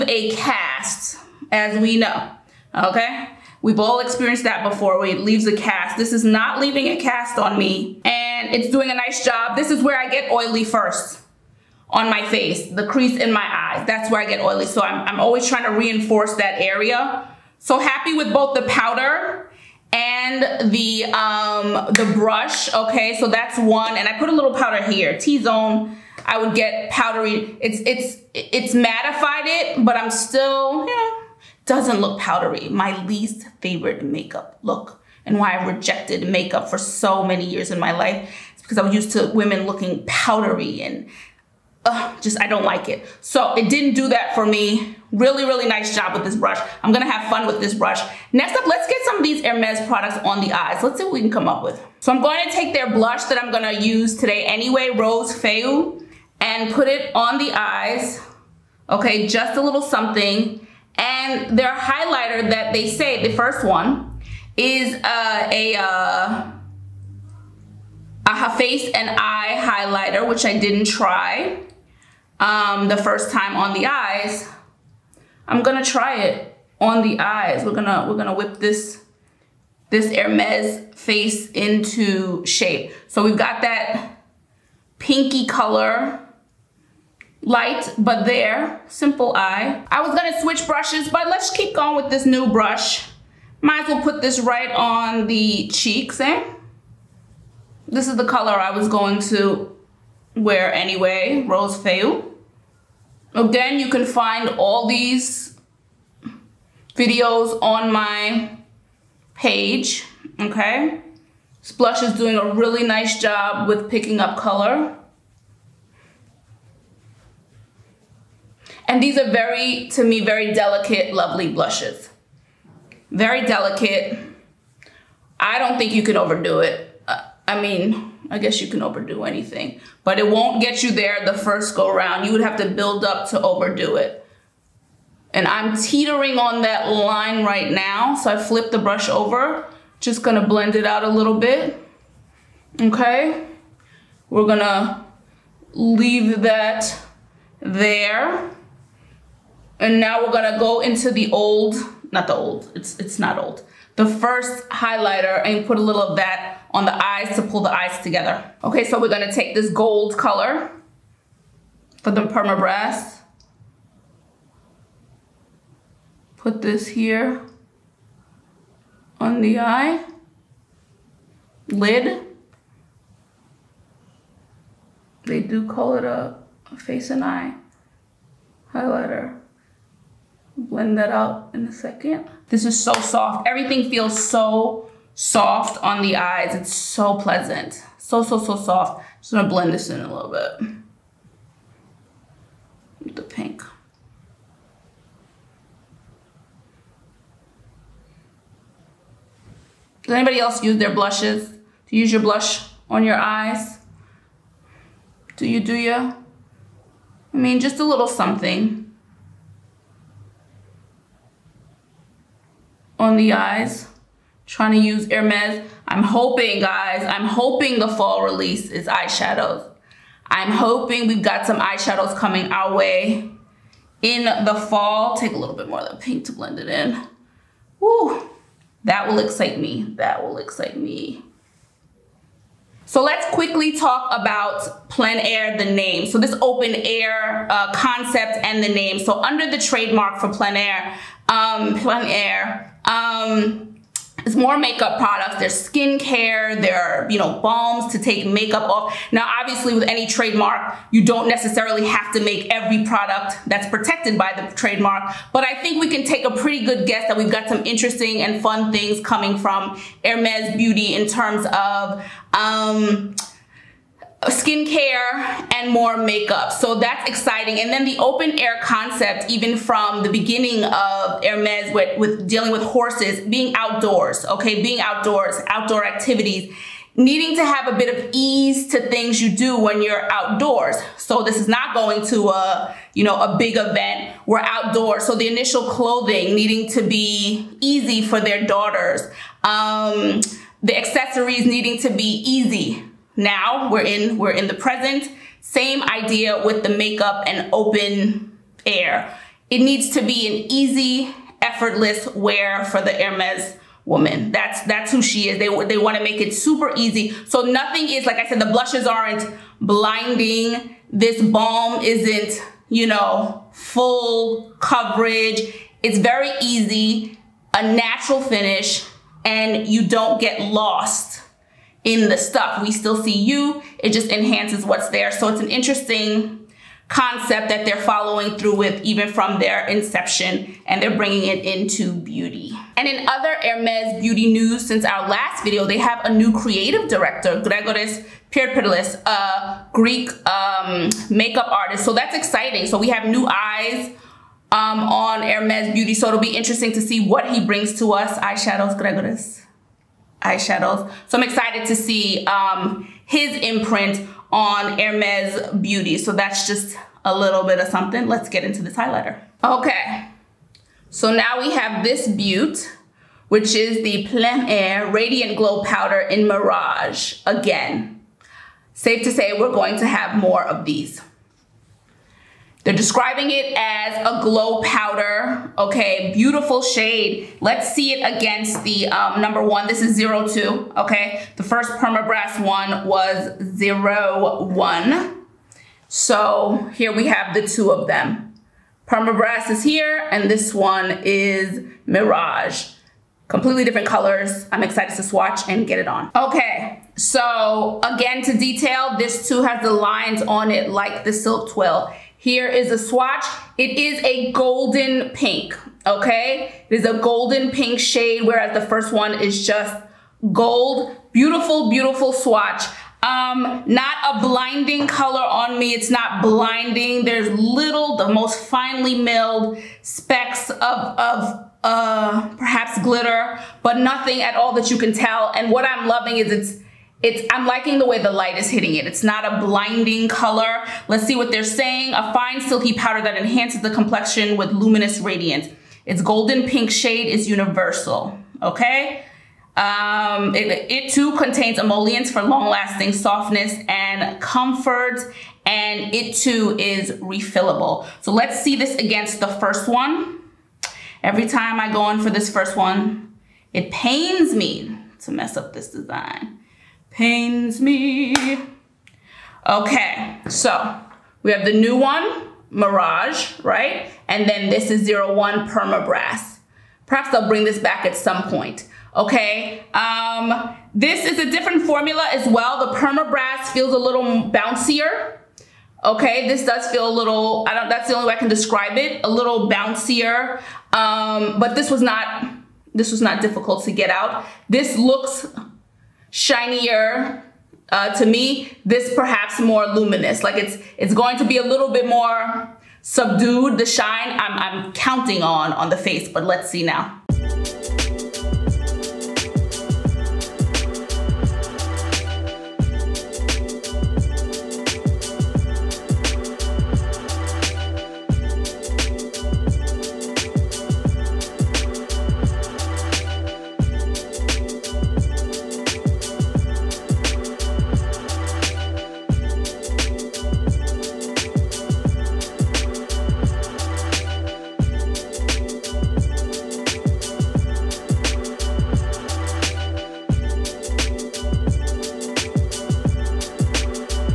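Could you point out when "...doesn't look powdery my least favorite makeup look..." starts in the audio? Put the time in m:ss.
0:31.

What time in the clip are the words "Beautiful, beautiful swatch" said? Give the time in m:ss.
6:51.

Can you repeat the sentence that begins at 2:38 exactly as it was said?
Okay, so we're gonna take this gold color for the Permabrass.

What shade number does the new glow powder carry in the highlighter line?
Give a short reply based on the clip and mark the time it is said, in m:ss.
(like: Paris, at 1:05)
02, at 6:19.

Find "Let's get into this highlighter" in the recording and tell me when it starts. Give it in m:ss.
5:58.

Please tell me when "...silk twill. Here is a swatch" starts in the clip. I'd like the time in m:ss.
6:41.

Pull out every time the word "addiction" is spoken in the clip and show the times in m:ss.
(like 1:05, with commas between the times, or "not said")
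not said.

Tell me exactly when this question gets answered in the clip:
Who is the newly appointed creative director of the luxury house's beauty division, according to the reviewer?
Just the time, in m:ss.
5:37.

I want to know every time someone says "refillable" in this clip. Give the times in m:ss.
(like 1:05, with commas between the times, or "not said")
7:26.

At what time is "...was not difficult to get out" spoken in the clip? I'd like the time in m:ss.
8:02.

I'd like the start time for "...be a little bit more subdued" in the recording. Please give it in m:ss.
8:11.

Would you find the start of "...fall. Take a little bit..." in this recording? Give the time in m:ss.
3:44.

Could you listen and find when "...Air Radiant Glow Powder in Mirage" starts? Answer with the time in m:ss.
6:04.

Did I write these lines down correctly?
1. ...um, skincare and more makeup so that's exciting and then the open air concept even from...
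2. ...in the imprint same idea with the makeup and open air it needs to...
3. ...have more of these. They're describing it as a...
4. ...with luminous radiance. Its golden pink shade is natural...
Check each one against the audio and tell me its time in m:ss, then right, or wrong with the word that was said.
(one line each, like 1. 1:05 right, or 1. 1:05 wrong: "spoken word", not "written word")
1. 4:22 right
2. 4:54 wrong: "present", not "imprint"
3. 6:09 right
4. 7:14 wrong: "universal", not "natural".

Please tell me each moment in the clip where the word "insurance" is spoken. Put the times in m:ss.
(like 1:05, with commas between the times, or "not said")
not said.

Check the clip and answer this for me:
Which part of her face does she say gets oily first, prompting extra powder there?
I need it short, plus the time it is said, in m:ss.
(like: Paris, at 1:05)
The crease in my eyes, at 0:12.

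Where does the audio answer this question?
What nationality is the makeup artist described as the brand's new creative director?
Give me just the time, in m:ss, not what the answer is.
5:39.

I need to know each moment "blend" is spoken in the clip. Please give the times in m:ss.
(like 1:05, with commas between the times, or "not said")
2:20, 3:00, 3:09, 3:46.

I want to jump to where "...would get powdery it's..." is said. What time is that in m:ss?
0:26.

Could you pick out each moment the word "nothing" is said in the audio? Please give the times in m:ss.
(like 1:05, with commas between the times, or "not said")
5:07, 7:03.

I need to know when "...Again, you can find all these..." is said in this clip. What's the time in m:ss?
1:43.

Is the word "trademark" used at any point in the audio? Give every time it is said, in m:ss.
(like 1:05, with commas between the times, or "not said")
3:59, 4:10, 4:14.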